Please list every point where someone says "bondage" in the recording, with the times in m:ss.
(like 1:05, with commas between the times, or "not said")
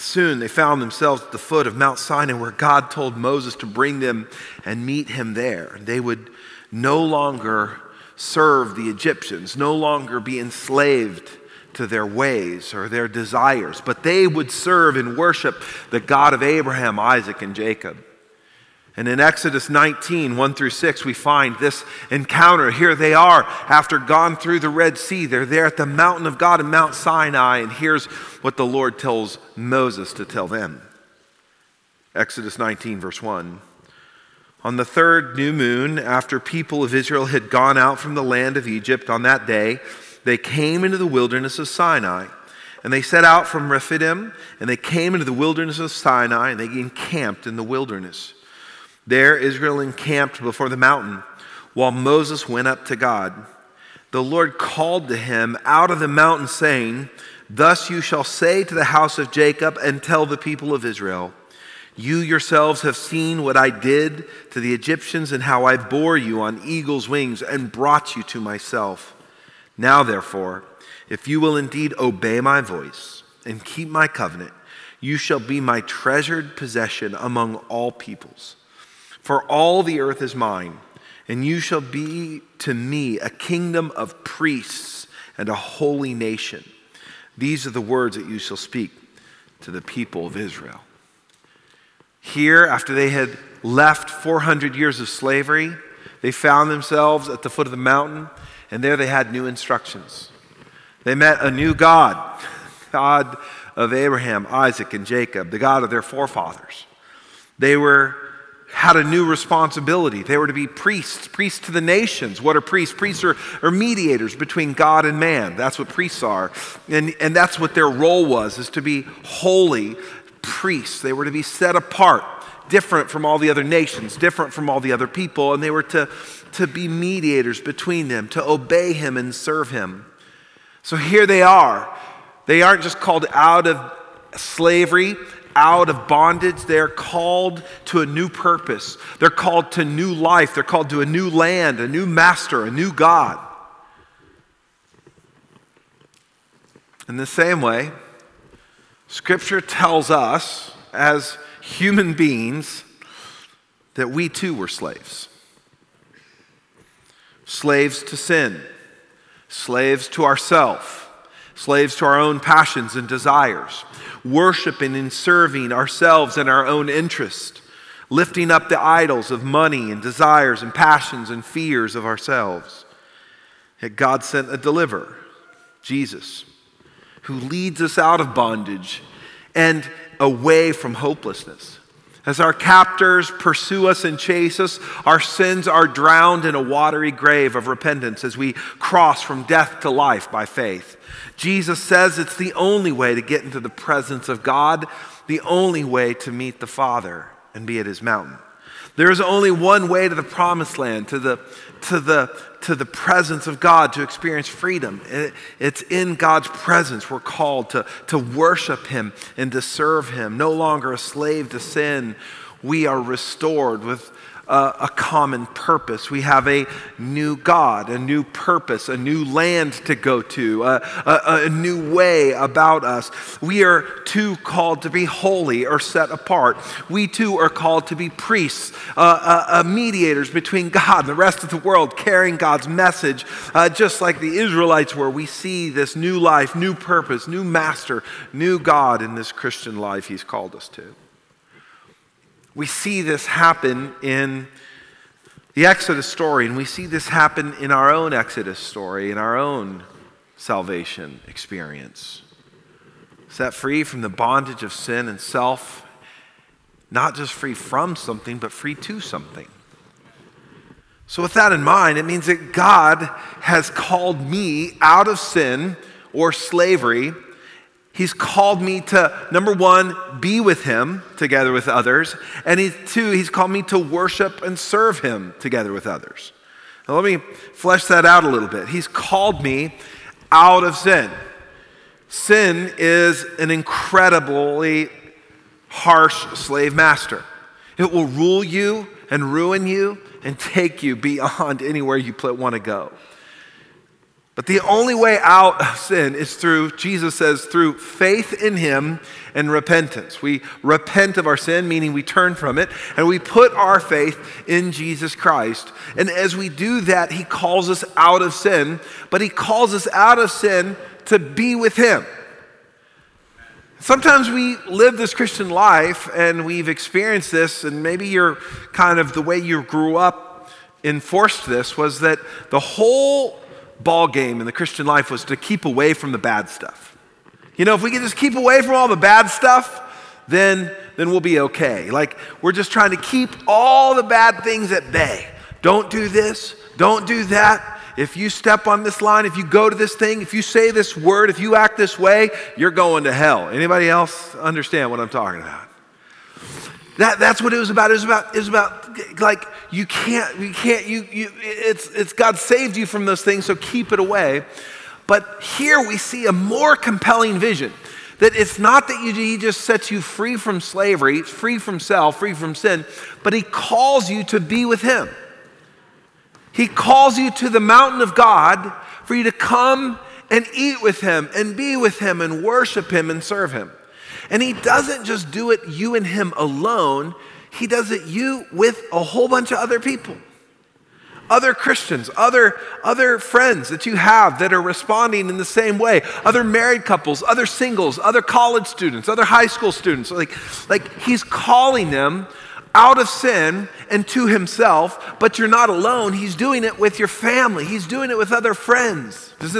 2:16, 2:58, 4:14.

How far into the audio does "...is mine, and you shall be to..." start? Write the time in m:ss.
1:20.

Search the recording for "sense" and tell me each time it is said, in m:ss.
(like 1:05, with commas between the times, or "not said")
not said.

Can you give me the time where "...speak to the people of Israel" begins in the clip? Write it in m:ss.
1:28.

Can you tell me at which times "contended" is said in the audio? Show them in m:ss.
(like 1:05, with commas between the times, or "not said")
not said.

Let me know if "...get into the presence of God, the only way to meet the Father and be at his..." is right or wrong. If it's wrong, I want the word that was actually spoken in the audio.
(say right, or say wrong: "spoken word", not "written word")
right.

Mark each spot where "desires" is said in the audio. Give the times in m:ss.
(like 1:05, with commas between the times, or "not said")
0:13, 2:43, 2:50.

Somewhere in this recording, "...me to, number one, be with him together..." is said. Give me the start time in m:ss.
4:28.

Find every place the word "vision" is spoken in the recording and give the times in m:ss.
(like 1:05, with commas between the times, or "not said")
5:57.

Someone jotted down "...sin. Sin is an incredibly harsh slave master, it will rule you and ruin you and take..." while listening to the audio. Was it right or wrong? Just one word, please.
right.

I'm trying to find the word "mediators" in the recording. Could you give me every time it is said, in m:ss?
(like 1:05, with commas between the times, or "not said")
1:53, 2:06, 3:49.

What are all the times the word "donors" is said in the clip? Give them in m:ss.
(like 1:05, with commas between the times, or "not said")
not said.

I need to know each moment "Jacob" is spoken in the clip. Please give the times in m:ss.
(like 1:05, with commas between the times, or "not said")
0:17, 0:59, 1:45.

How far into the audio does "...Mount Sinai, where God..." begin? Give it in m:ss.
0:01.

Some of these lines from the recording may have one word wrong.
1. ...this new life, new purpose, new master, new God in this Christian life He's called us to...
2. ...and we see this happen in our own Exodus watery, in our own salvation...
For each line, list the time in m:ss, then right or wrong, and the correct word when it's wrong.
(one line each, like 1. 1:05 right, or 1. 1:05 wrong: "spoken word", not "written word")
1. 3:55 right
2. 4:06 wrong: "story", not "watery".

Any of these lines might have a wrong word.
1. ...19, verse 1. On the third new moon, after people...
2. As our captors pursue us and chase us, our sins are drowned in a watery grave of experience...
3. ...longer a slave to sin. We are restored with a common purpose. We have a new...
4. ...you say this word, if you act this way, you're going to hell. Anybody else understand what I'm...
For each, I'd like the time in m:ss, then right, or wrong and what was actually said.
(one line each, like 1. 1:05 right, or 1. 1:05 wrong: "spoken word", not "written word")
1. 0:32 right
2. 3:02 wrong: "repentance", not "experience"
3. 3:30 right
4. 5:40 right.